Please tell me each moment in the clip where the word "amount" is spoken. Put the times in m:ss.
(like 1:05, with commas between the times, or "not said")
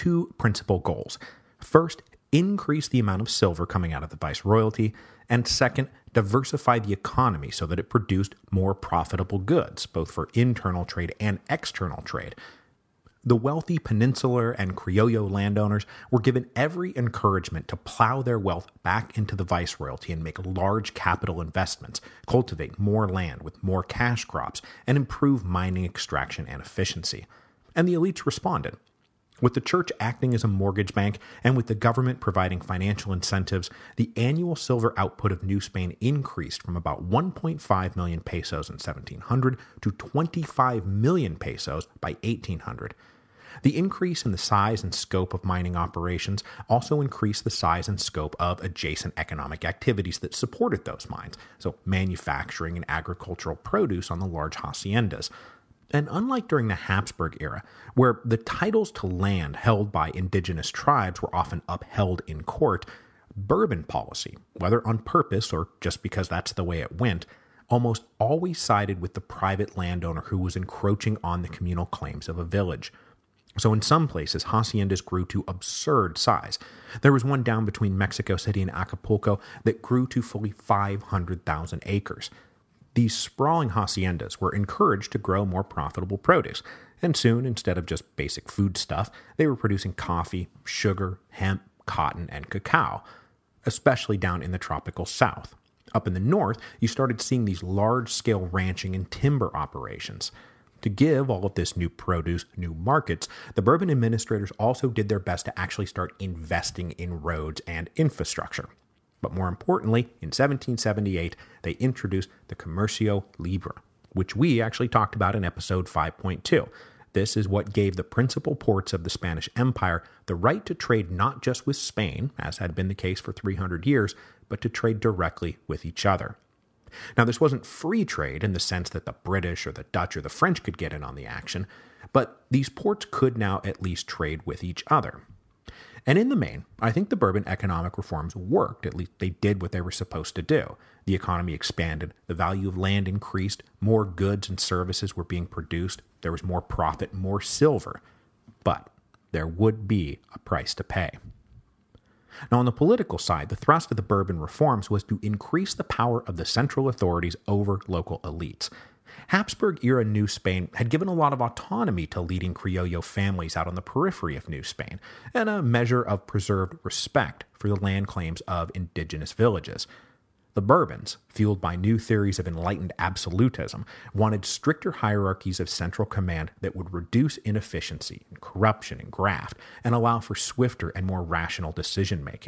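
0:02.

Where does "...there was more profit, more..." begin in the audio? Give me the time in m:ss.
2:26.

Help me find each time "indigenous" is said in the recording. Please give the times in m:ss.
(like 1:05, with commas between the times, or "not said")
1:00, 2:48.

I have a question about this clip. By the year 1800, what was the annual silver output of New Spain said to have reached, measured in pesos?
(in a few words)
25 million pesos.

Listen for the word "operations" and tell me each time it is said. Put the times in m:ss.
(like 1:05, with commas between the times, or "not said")
0:45, 1:39.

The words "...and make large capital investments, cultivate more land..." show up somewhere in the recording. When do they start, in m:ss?
0:20.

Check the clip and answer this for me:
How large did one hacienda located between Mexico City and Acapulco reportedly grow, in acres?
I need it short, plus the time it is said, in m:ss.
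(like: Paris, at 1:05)
500,000 acres, at 1:20.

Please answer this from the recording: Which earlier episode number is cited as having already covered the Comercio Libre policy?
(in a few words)
5.2.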